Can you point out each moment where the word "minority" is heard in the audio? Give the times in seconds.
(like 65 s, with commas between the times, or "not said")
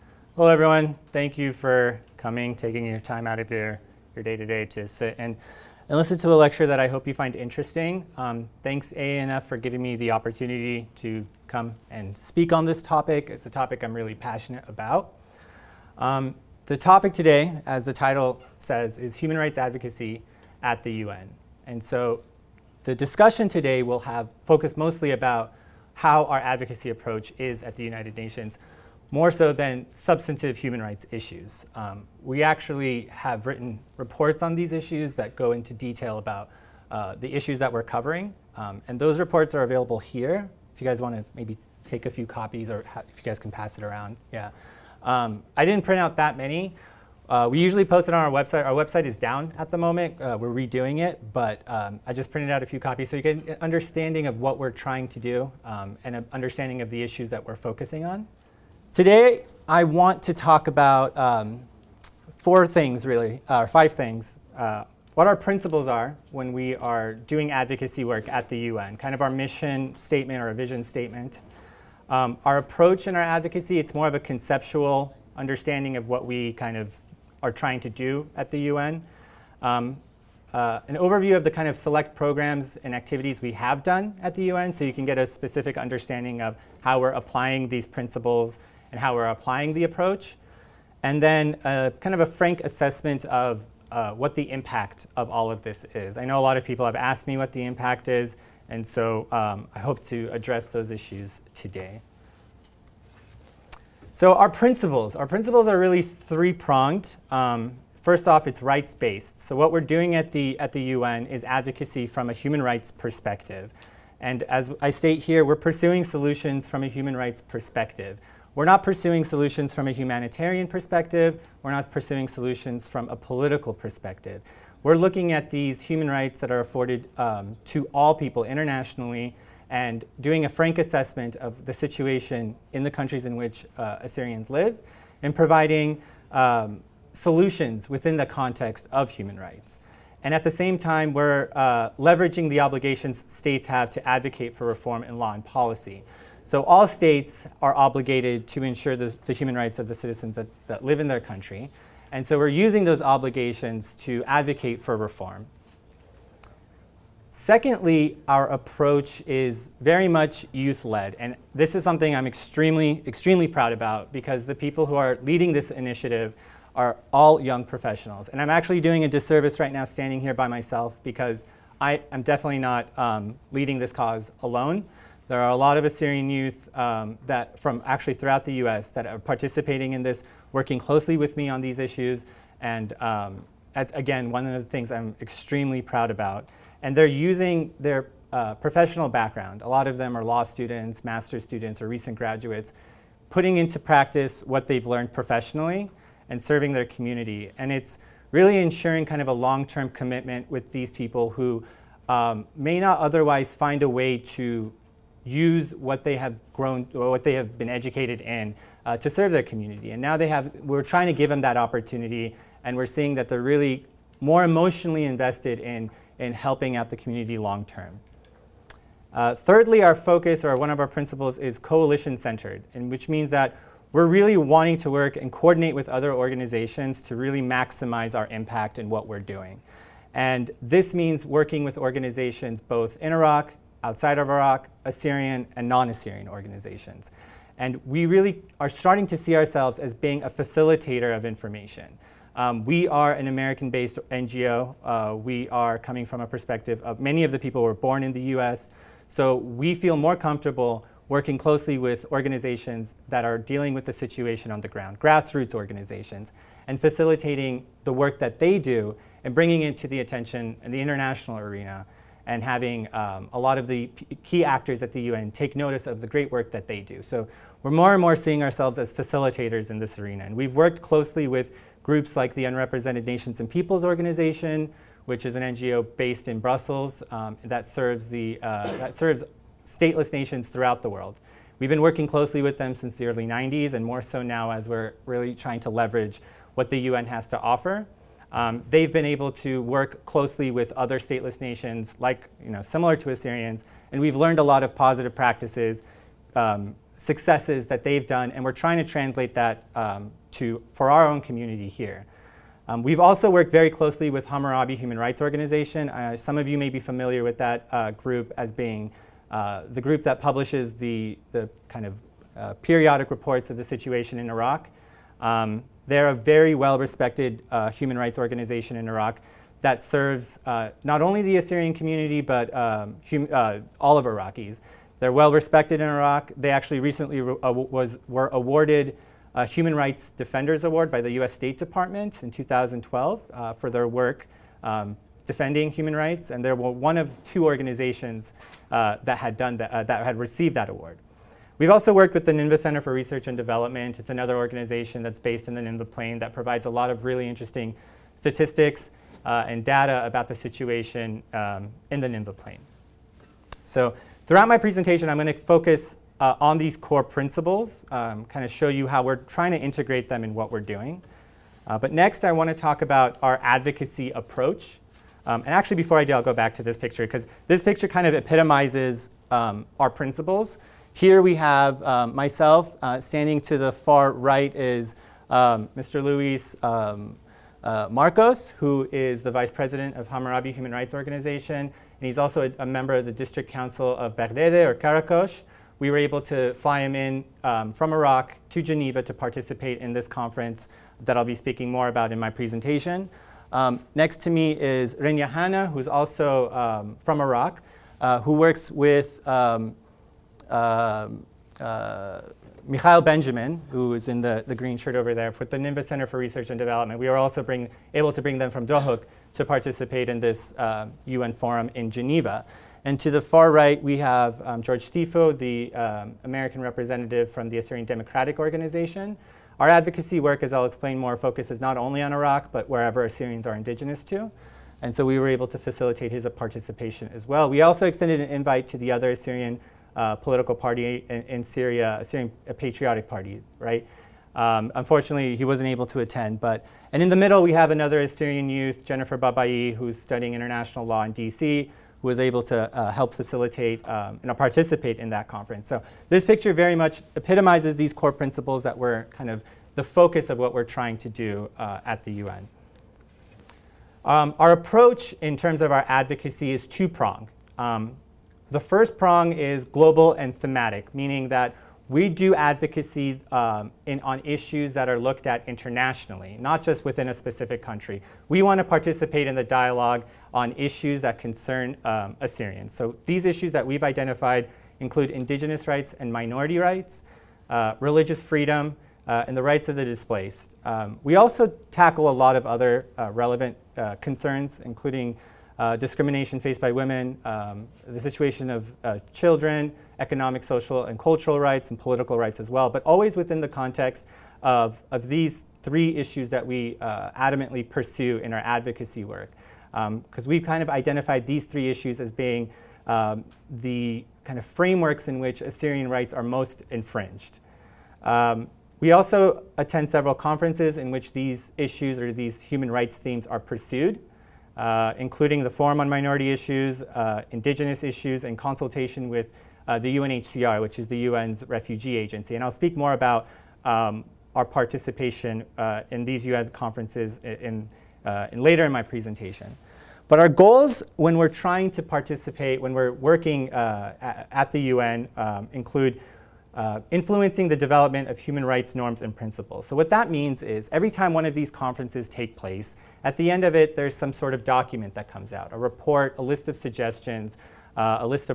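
476 s, 515 s.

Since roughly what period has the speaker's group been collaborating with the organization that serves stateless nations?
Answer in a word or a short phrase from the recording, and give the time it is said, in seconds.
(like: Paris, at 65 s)
the early 90s, at 283 s.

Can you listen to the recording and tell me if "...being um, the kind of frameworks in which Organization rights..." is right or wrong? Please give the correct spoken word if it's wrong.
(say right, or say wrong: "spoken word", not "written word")
wrong: "Assyrian", not "Organization".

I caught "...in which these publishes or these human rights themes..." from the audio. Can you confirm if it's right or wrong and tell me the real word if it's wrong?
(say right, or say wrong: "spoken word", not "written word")
wrong: "issues", not "publishes".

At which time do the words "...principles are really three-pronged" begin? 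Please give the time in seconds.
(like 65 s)
105 s.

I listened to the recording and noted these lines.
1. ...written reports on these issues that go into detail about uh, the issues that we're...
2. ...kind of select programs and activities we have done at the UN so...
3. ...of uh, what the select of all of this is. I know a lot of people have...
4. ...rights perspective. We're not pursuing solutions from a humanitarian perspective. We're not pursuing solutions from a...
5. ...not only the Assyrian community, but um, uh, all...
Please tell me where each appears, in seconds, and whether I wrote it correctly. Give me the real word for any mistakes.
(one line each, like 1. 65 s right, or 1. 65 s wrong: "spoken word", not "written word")
1. 33 s right
2. 81 s right
3. 93 s wrong: "impact", not "select"
4. 117 s right
5. 320 s right.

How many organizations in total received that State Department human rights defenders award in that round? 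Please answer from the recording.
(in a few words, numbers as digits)
2.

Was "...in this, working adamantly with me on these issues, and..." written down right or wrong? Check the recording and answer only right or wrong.
wrong.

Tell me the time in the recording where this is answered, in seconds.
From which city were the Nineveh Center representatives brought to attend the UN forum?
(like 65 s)
408 s.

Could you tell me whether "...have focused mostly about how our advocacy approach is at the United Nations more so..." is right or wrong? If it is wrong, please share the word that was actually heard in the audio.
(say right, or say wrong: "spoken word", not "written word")
right.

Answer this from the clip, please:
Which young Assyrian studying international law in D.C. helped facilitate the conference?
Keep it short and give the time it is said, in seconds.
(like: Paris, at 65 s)
Jennifer Babayi, at 438 s.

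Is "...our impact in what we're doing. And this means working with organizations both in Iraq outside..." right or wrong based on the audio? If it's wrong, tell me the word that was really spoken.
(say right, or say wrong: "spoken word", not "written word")
right.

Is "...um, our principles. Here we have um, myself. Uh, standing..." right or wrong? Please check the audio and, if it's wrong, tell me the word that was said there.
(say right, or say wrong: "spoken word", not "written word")
right.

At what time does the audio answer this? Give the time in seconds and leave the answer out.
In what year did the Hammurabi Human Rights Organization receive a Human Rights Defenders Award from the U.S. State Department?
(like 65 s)
332 s.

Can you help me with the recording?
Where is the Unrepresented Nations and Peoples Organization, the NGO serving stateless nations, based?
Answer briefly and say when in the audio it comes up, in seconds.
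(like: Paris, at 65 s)
Brussels, at 276 s.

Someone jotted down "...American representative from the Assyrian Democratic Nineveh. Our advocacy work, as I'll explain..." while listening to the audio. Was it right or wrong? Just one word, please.
wrong.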